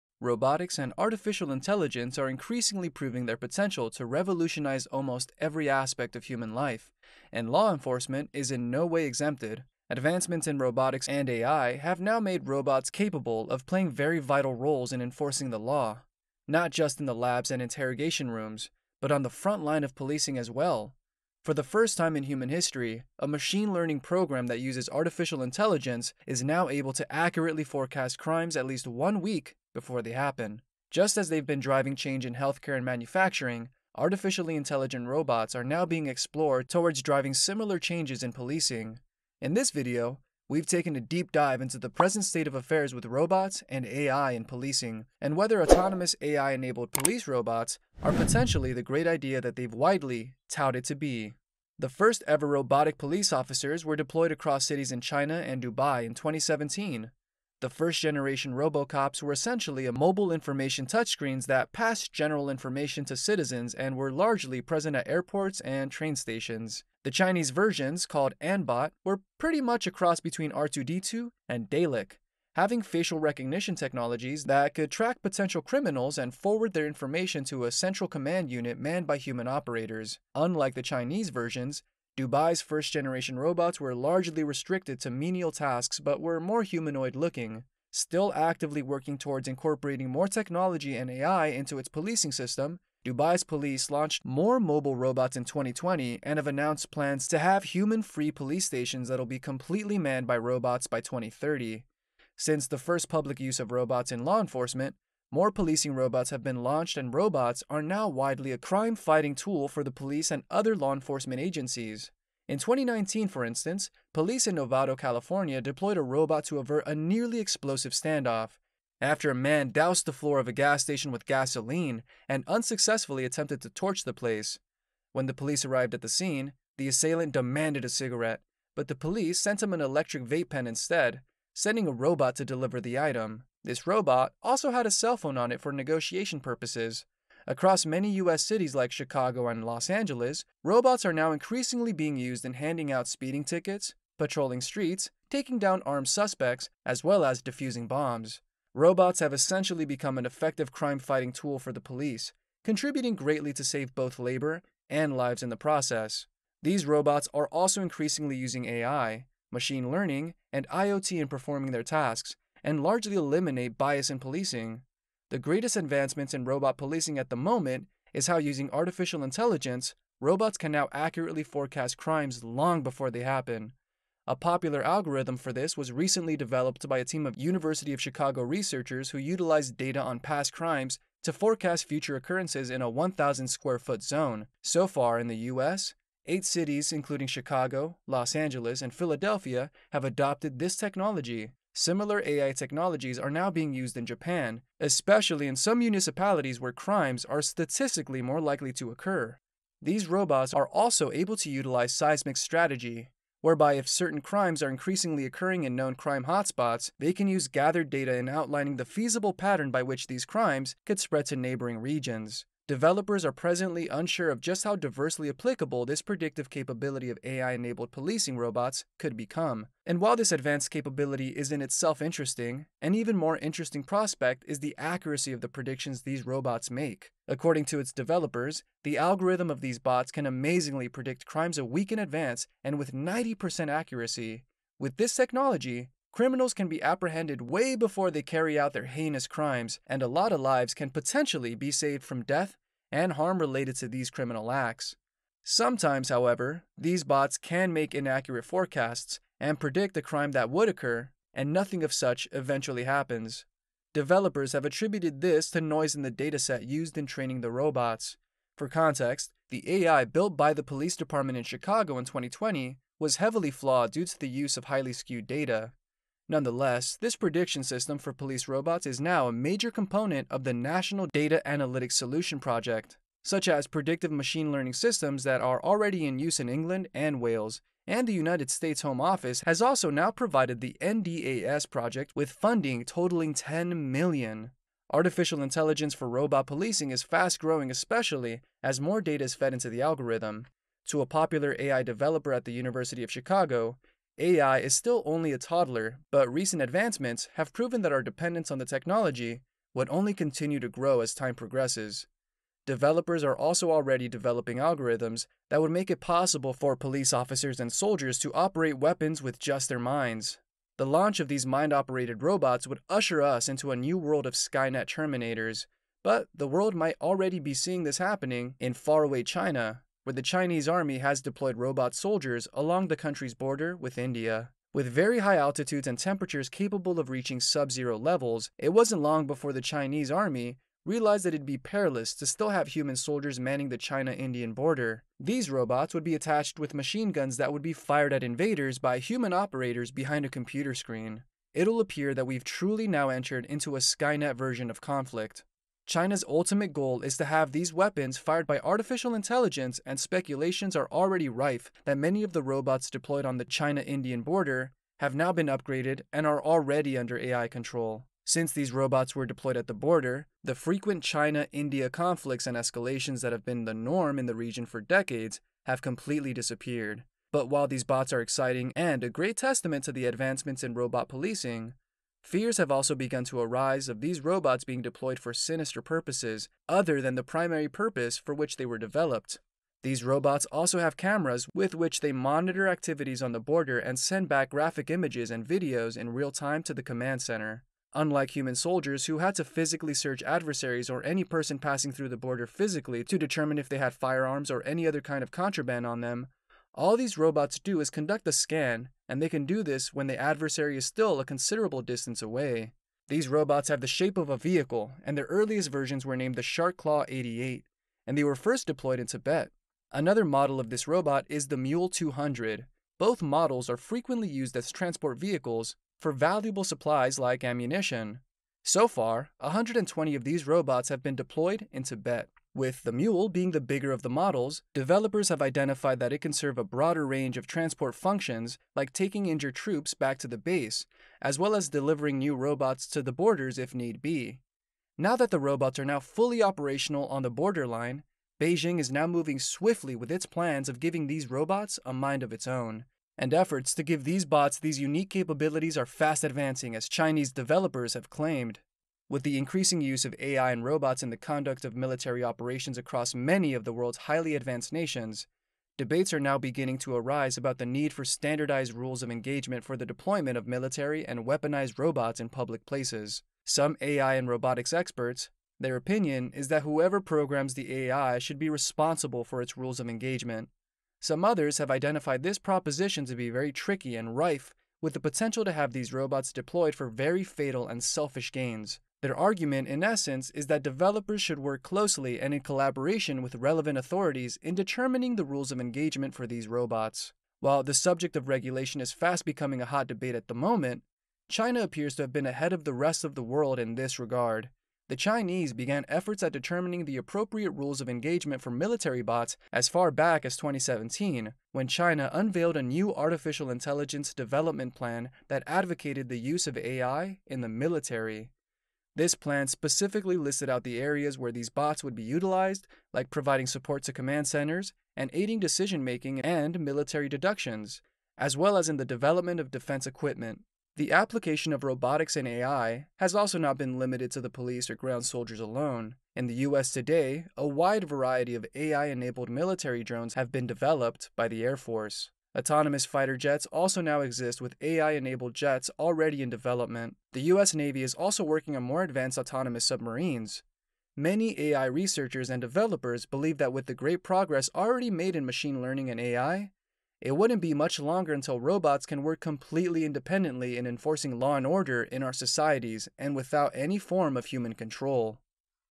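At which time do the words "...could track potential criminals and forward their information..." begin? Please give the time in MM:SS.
01:14.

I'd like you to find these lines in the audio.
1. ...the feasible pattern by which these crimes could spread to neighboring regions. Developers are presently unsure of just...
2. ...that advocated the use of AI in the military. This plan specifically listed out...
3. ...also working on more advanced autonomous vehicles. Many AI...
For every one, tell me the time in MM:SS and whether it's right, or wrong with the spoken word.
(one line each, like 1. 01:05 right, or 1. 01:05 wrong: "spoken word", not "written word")
1. 03:28 right
2. 08:25 right
3. 08:57 wrong: "submarines", not "vehicles".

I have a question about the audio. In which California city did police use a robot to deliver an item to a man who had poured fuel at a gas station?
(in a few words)
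Novato.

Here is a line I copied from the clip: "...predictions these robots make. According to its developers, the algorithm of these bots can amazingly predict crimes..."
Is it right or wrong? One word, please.
right.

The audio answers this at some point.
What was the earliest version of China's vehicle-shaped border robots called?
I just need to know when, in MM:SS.
06:46.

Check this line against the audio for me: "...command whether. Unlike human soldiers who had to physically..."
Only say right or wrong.
wrong.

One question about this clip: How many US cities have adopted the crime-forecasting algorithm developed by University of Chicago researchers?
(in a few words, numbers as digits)
8.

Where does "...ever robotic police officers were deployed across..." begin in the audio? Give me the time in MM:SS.
00:52.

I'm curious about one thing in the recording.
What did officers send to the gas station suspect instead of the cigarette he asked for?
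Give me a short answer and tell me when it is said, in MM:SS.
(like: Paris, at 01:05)
electric vape pen, at 02:09.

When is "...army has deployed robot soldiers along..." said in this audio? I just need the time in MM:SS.
05:20.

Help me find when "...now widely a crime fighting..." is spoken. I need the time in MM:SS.
01:47.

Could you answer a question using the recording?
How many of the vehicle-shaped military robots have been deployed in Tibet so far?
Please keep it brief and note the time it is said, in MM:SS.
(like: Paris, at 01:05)
120, at 06:59.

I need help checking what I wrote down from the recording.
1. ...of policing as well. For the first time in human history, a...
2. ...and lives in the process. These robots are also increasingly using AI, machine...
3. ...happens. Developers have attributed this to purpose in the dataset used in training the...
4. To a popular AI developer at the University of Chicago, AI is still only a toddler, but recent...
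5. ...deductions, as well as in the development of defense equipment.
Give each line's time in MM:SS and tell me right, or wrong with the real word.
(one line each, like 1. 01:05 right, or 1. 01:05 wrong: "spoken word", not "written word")
1. 00:19 right
2. 02:34 right
3. 04:12 wrong: "noise", not "purpose"
4. 04:50 right
5. 08:37 right.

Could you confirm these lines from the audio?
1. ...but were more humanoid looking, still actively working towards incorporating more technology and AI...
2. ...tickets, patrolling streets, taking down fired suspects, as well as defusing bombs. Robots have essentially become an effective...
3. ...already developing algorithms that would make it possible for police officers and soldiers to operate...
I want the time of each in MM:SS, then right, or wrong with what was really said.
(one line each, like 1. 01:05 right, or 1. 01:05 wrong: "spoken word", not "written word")
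1. 01:26 right
2. 02:23 wrong: "armed", not "fired"
3. 05:03 right.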